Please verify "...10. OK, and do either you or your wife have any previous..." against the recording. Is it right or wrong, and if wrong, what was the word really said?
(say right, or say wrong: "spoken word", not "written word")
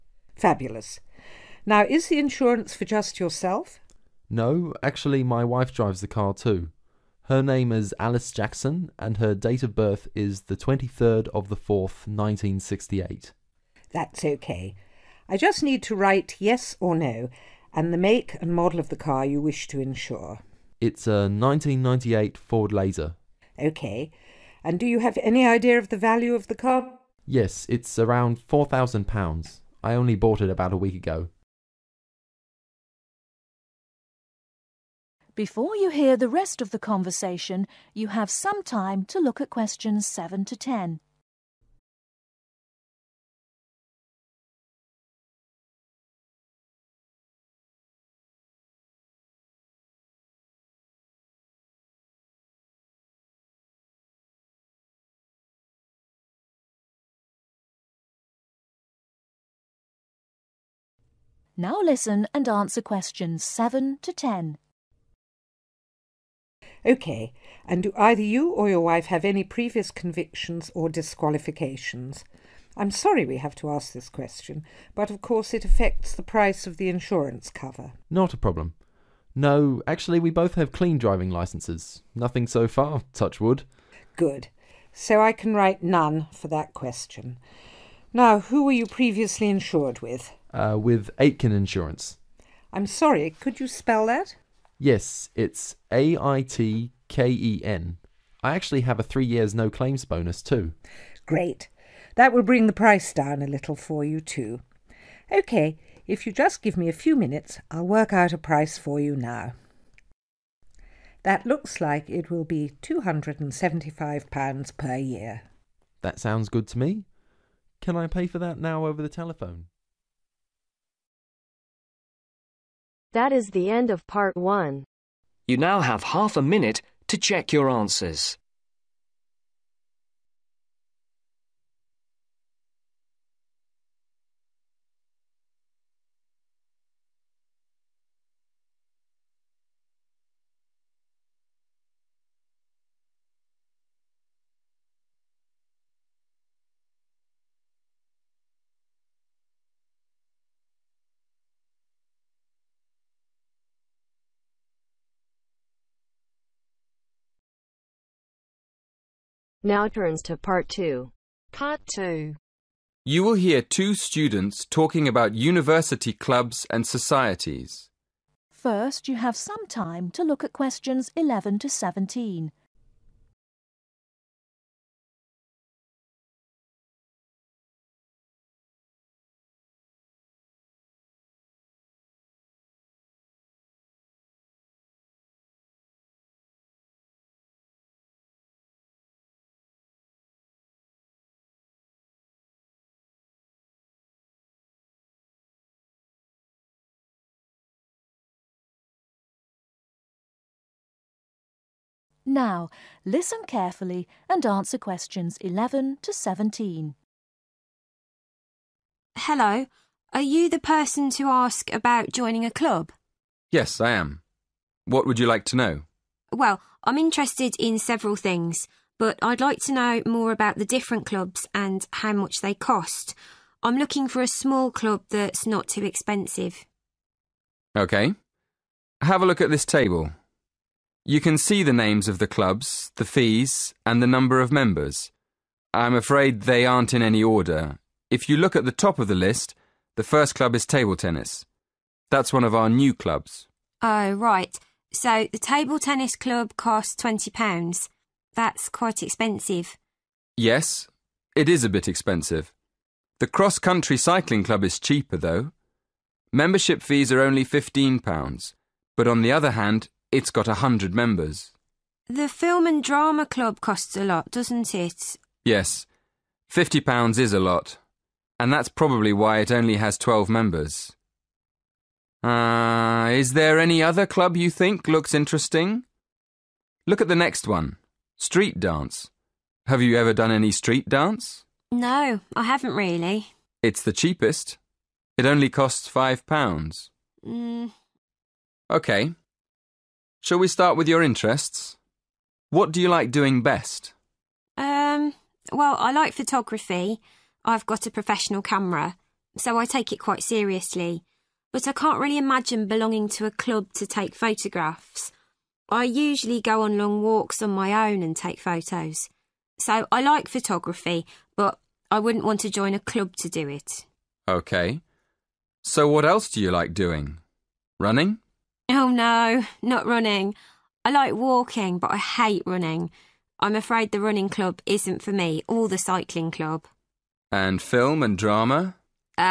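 right.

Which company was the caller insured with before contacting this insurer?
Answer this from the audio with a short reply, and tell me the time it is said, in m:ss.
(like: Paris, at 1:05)
Aitken Insurance, at 1:31.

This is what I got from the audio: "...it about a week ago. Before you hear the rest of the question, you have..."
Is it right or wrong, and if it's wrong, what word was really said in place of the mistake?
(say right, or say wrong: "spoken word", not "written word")
wrong: "conversation", not "question".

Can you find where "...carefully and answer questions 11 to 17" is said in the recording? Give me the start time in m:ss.
3:23.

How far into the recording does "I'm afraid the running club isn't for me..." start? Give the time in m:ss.
5:23.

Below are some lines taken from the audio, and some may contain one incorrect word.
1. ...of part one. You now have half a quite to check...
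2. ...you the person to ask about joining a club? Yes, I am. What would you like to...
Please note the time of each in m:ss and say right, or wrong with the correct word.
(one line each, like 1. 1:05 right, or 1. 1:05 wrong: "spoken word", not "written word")
1. 2:03 wrong: "minute", not "quite"
2. 3:30 right.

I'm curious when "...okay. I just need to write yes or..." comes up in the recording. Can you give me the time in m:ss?
0:14.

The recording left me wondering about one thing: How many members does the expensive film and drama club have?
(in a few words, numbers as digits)
12.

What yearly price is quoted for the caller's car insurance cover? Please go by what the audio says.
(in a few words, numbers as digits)
£275.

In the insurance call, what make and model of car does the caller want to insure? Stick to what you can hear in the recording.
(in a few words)
Ford Laser.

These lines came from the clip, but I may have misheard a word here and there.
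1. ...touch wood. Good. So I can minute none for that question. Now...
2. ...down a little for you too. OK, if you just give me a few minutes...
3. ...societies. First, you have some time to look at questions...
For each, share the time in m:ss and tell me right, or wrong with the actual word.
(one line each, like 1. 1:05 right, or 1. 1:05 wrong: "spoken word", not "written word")
1. 1:23 wrong: "write", not "minute"
2. 1:43 right
3. 2:46 right.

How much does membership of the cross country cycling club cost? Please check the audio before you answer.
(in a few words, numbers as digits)
£15.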